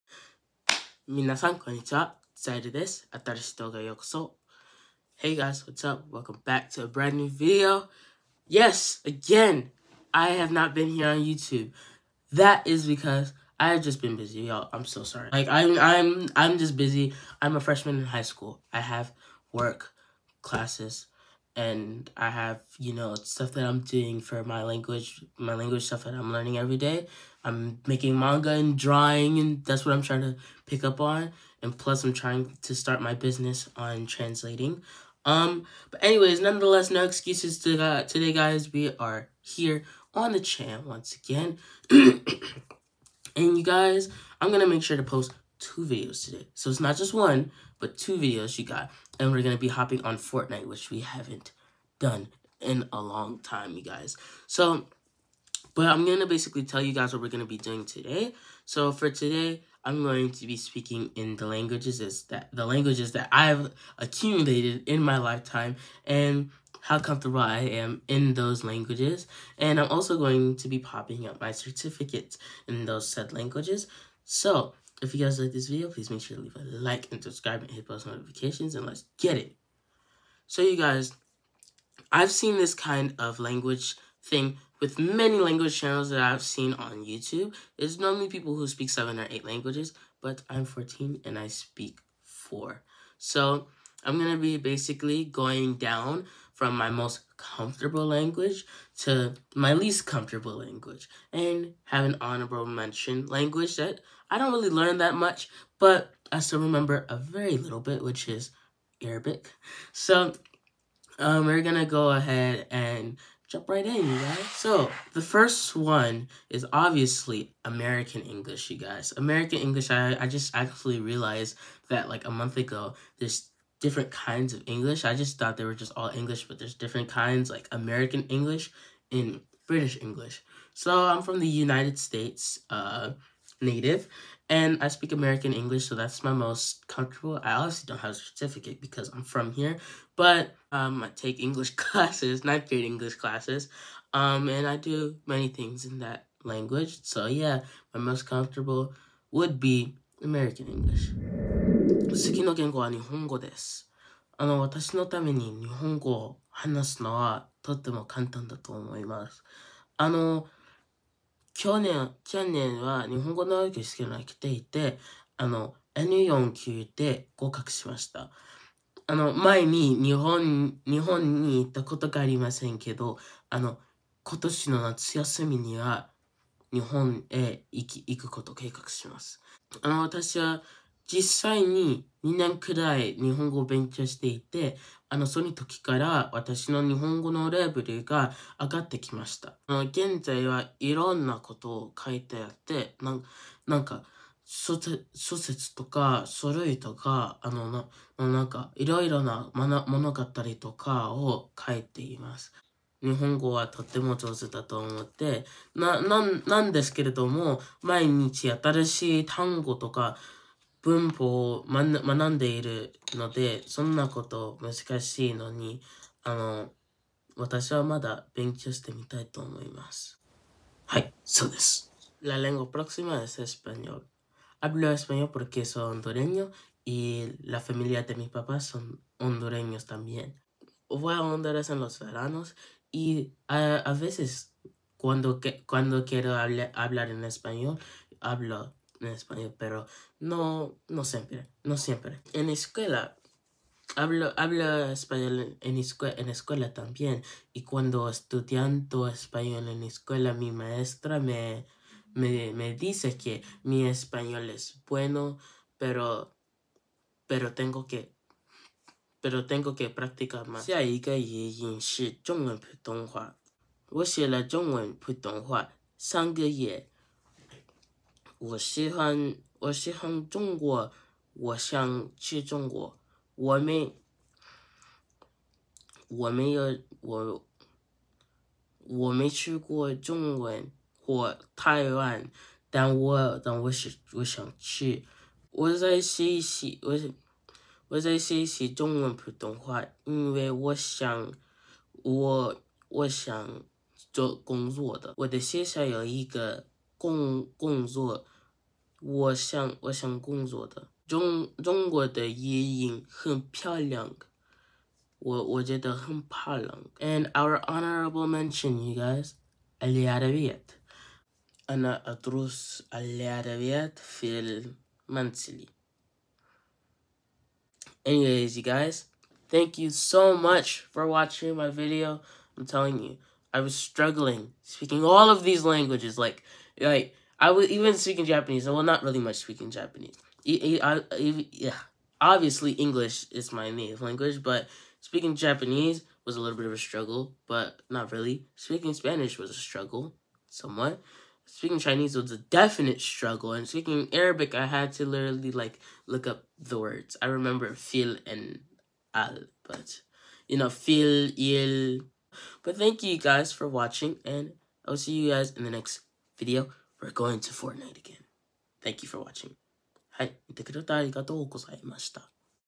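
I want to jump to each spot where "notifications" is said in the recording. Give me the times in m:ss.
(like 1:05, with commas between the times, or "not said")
1:18.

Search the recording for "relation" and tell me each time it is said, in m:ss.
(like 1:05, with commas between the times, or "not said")
not said.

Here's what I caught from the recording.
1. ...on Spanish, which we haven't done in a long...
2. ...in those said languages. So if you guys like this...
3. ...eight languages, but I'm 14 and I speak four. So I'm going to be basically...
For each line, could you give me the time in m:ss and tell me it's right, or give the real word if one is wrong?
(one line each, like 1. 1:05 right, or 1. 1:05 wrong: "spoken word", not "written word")
1. 0:50 wrong: "Fortnite", not "Spanish"
2. 1:12 right
3. 1:29 right.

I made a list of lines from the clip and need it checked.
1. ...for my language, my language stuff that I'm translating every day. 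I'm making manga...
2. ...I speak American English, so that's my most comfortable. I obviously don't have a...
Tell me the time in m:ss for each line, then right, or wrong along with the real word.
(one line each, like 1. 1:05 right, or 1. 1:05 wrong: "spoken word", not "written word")
1. 0:24 wrong: "learning", not "translating"
2. 2:14 right.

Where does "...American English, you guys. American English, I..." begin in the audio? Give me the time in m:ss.
1:57.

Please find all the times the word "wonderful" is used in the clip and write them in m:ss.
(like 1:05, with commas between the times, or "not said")
not said.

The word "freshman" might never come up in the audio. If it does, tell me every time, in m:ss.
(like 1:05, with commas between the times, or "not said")
0:17.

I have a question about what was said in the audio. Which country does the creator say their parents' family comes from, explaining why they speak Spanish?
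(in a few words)
Honduras.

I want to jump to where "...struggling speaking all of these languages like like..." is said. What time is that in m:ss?
5:23.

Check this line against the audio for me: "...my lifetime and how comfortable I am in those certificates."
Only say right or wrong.
wrong.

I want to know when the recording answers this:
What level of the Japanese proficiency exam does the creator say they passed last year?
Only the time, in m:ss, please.
2:45.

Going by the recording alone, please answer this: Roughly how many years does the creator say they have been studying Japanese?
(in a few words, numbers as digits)
2.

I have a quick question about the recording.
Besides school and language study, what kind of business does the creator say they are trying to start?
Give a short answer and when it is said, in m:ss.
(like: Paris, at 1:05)
Translating, at 0:34.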